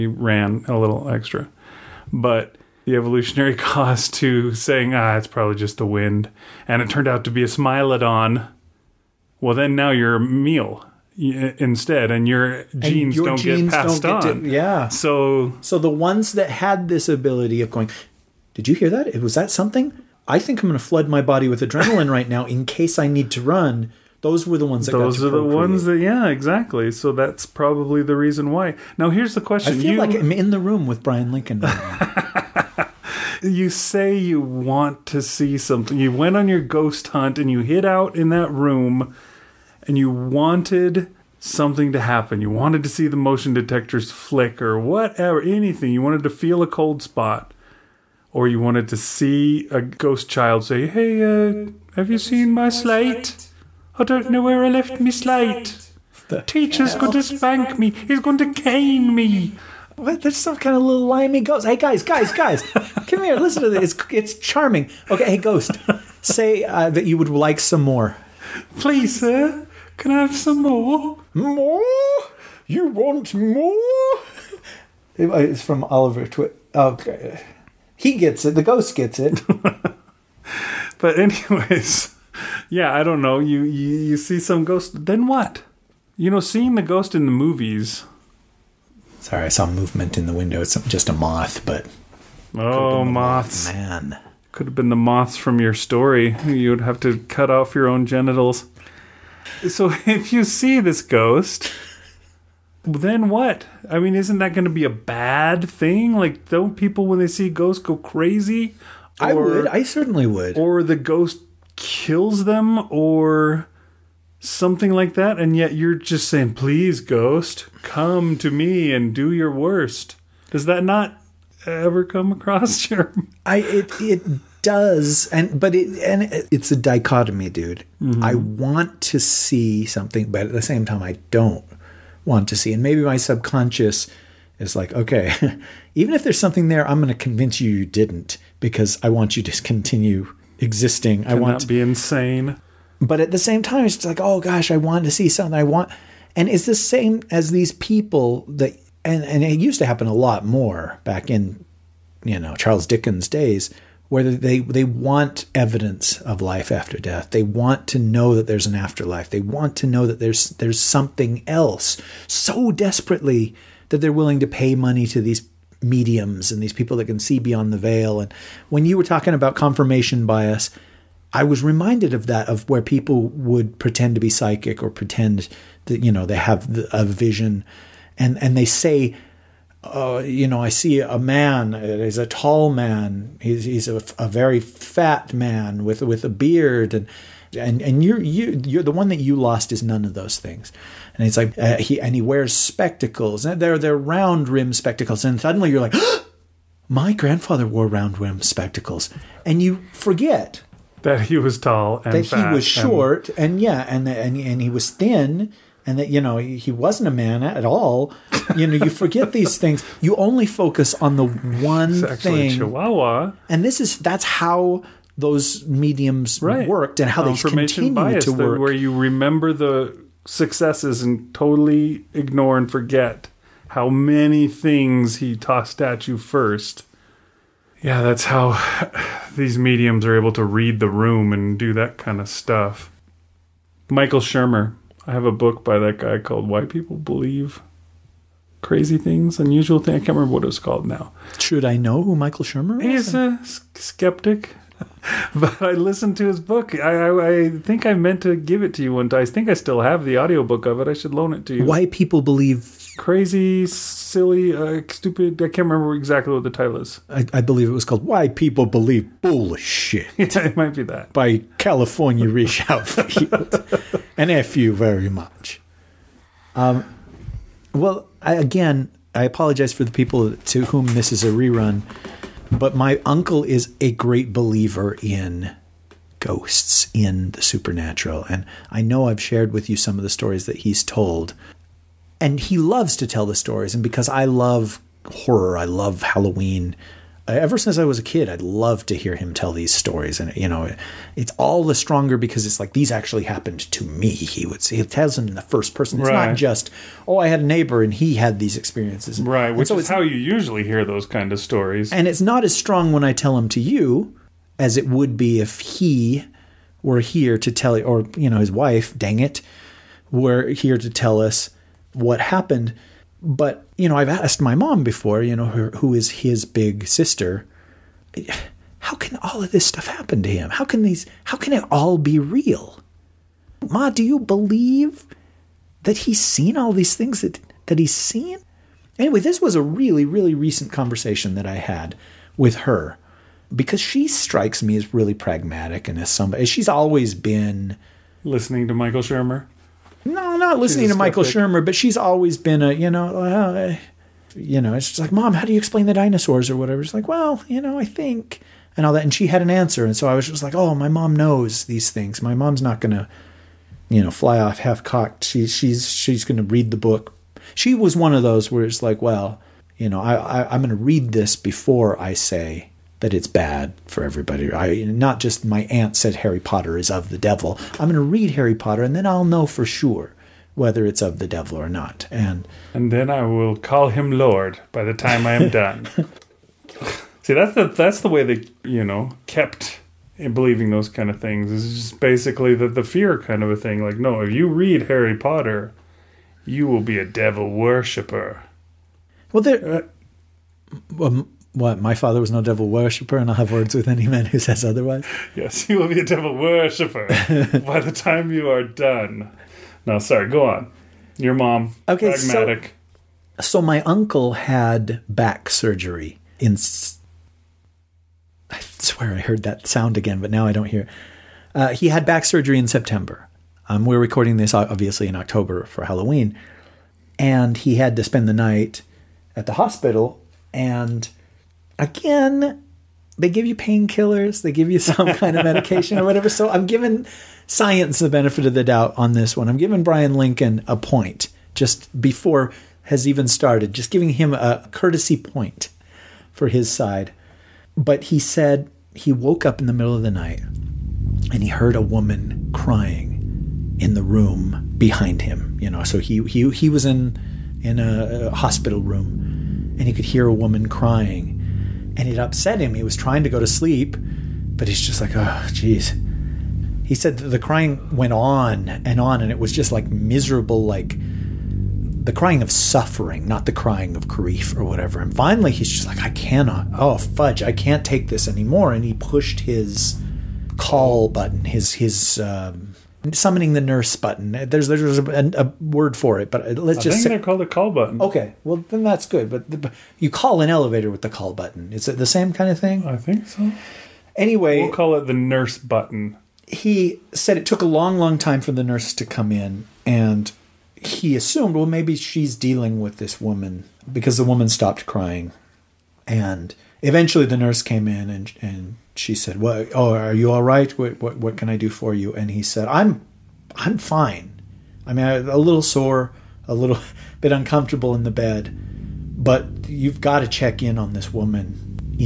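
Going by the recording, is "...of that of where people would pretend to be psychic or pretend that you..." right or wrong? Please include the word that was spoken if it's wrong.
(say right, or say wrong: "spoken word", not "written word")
right.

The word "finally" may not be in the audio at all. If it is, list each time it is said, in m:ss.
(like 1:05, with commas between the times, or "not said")
7:45.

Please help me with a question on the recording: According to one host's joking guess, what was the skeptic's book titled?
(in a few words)
Why People Believe Bullshit.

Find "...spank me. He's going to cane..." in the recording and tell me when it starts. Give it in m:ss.
0:57.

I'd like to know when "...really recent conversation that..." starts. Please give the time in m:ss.
5:30.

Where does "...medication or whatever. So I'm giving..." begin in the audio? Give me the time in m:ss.
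7:05.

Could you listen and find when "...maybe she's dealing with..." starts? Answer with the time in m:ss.
8:11.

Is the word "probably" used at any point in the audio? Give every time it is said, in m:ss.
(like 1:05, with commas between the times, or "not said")
0:05, 0:27.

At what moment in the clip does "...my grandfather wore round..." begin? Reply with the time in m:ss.
3:16.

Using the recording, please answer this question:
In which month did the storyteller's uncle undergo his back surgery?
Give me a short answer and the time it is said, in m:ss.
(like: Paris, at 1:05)
September, at 6:52.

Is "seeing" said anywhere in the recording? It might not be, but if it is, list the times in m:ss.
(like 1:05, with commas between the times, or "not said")
1:26.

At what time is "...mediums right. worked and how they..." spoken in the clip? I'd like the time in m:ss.
3:35.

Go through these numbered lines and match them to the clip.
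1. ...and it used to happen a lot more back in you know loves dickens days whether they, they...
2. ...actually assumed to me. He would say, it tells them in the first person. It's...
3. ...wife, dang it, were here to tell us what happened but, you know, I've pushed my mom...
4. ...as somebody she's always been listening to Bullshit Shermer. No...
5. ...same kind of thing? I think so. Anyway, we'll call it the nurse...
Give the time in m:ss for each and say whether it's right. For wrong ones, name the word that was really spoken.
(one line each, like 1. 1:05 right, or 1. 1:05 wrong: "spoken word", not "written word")
1. 2:29 wrong: "charles", not "loves"
2. 4:52 wrong: "happened", not "assumed"
3. 5:08 wrong: "asked", not "pushed"
4. 5:35 wrong: "Michael", not "Bullshit"
5. 8:02 right.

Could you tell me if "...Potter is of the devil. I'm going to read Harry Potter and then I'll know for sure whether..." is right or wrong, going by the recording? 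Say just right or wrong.
right.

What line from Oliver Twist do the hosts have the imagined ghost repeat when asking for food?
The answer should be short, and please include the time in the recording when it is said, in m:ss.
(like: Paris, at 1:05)
Please, sir. Can I have some more?, at 1:08.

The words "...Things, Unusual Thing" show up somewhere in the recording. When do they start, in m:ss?
3:58.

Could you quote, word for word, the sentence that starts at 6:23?
Like, no, if you read Harry Potter, you will be a devil worshipper.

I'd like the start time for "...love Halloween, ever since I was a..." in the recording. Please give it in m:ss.
4:45.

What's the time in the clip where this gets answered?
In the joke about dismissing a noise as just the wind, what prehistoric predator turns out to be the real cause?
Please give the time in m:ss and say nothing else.
0:07.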